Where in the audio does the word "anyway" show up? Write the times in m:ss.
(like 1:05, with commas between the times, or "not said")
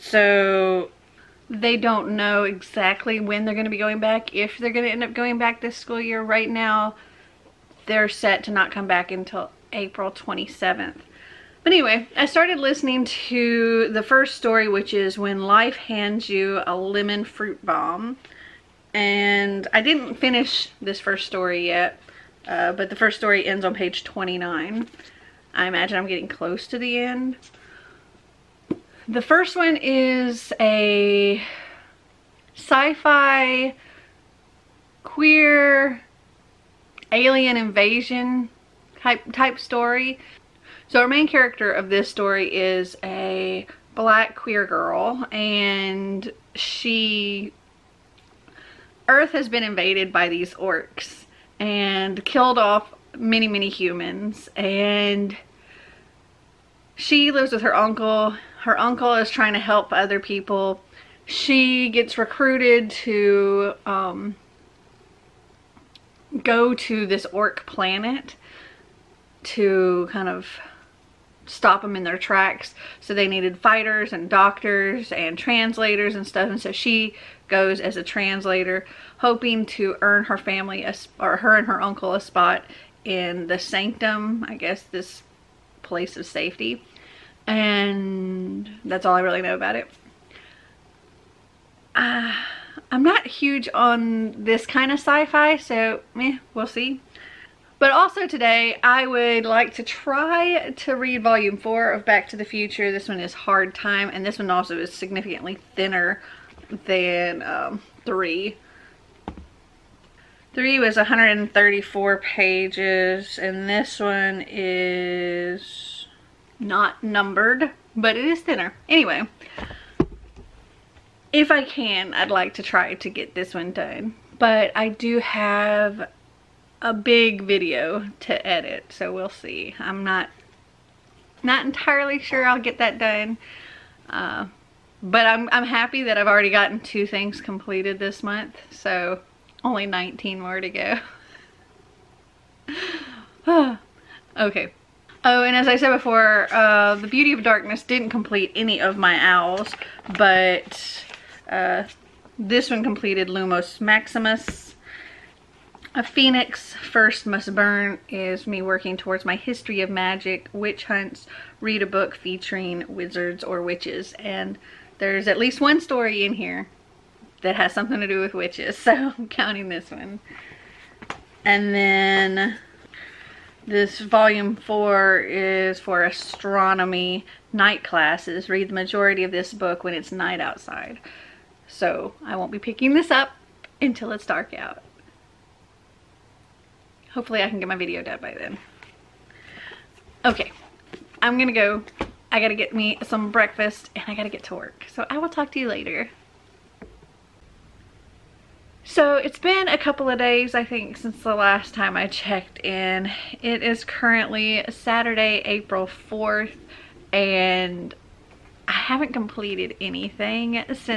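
0:11, 1:58.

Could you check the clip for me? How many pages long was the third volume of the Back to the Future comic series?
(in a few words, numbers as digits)
134.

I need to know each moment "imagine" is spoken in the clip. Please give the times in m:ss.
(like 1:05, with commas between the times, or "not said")
0:25.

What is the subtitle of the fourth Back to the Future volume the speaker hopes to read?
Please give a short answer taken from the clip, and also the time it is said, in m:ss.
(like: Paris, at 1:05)
Hard Time, at 1:43.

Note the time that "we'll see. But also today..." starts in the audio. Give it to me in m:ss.
1:36.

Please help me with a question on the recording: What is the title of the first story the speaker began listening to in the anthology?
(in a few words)
When Life Hands You a Lemon Fruit Bomb.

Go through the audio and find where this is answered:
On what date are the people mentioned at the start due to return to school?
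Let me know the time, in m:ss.
0:09.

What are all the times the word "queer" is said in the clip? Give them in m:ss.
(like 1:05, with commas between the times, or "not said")
0:35, 0:44.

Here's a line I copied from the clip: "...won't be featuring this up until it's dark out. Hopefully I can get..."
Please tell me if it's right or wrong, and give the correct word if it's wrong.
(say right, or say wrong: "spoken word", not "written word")
wrong: "picking", not "featuring".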